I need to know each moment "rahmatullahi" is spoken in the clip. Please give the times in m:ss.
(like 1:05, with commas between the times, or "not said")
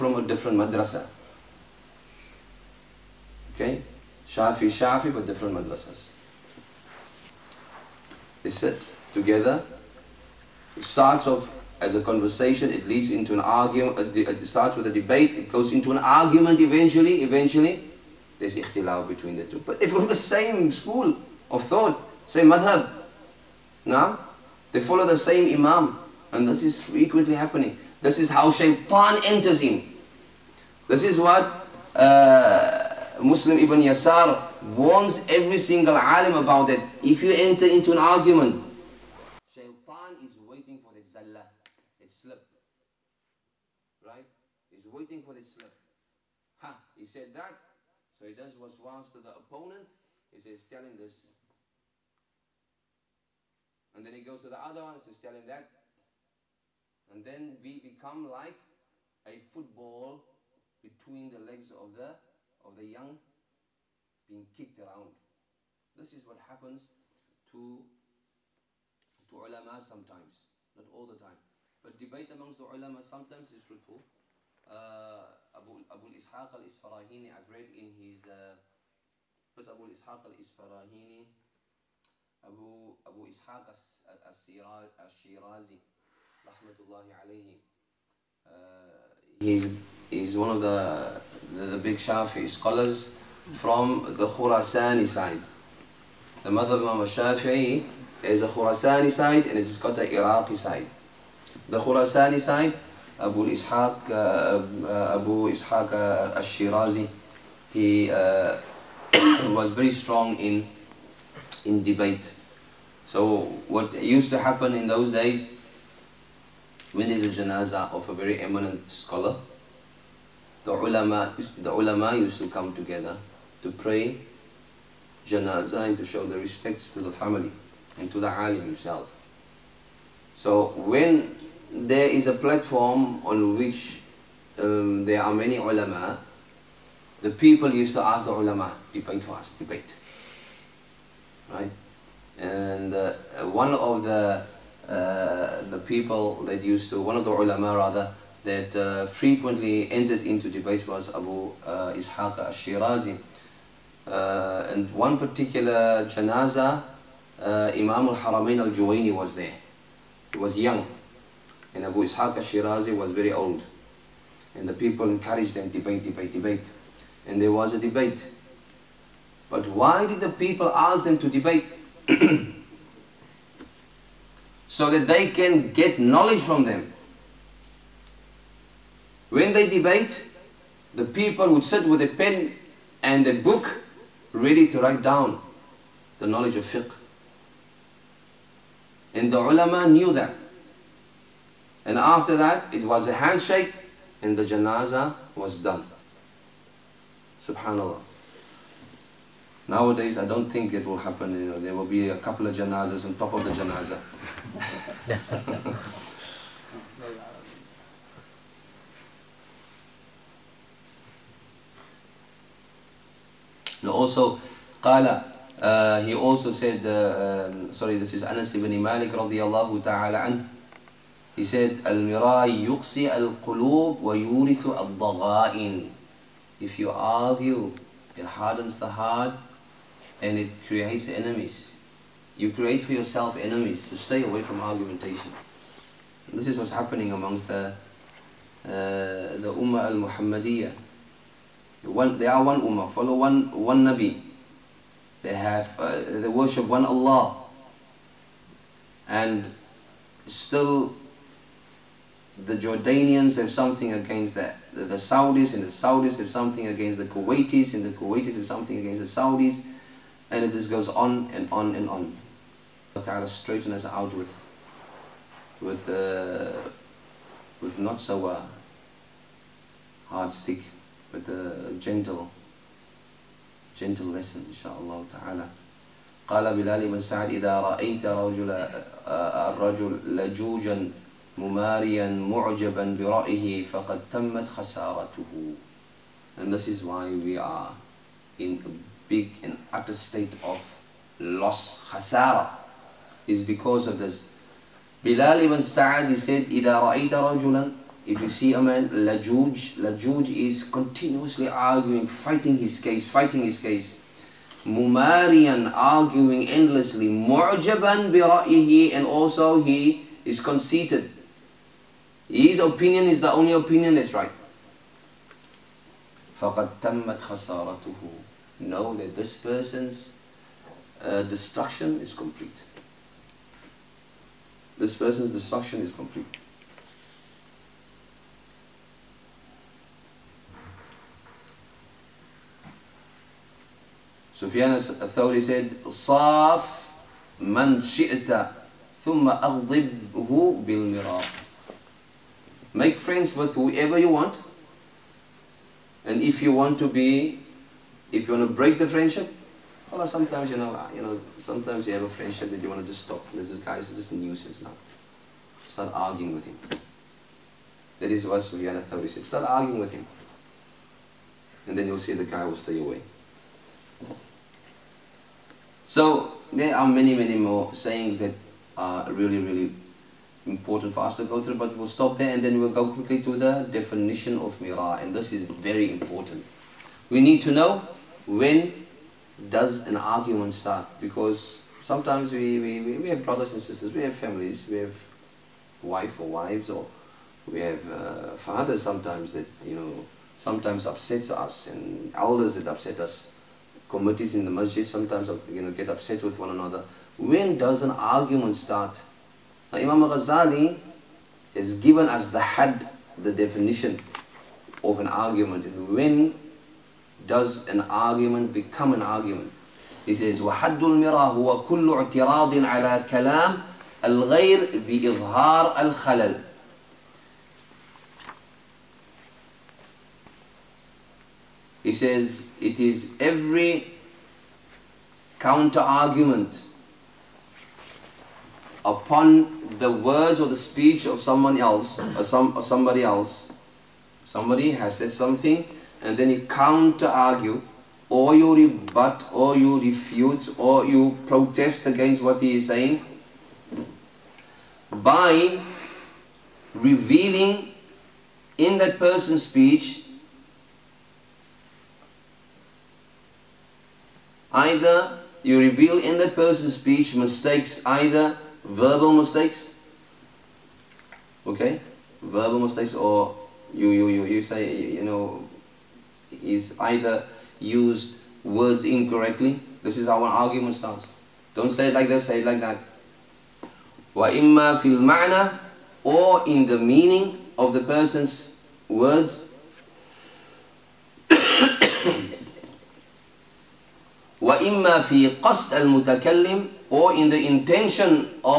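1:26.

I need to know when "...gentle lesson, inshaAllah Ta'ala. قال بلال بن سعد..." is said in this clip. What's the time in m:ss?
4:33.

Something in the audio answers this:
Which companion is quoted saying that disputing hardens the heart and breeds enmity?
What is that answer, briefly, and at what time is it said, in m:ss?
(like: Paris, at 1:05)
Anas ibn Malik, at 3:38.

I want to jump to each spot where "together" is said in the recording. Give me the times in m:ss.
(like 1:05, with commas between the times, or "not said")
0:09, 2:02.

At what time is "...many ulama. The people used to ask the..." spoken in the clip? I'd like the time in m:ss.
2:15.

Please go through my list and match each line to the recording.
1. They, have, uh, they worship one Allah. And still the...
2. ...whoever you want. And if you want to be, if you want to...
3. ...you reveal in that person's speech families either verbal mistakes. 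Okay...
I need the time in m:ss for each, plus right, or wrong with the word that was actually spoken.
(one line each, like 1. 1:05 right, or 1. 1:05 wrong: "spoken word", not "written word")
1. 4:05 right
2. 5:43 right
3. 7:35 wrong: "mistakes", not "families".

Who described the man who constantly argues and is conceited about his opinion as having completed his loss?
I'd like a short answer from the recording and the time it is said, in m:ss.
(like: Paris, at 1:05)
Bilal ibn Sa'ad, at 4:55.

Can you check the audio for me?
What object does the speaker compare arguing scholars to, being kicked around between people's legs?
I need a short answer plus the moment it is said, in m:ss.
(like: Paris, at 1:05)
a football, at 0:59.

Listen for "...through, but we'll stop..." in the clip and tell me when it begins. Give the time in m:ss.
6:11.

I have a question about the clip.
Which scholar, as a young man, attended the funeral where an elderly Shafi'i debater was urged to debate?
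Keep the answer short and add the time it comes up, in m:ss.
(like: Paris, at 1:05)
Imam al-Haramain al-Juwaini, at 2:37.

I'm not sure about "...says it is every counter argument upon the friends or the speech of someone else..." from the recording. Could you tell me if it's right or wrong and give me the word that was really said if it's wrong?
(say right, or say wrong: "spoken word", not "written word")
wrong: "words", not "friends".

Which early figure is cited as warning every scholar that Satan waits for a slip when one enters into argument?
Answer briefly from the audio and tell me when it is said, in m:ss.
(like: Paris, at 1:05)
Muslim Ibn Yasar, at 0:33.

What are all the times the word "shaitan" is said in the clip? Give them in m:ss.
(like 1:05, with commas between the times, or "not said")
0:28, 0:39.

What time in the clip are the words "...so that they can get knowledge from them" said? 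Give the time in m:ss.
2:54.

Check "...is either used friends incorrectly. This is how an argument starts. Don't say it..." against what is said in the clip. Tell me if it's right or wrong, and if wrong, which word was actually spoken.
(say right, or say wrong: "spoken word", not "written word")
wrong: "words", not "friends".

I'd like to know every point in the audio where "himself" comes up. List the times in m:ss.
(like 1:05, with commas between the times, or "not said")
2:08.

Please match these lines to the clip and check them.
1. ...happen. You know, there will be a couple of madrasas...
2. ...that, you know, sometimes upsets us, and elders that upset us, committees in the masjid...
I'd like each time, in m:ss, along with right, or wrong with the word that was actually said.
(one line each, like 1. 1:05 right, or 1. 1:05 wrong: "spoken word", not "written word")
1. 3:20 wrong: "janazas", not "madrasas"
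2. 6:29 right.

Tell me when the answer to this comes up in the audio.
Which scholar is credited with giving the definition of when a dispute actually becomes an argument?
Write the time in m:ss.
6:39.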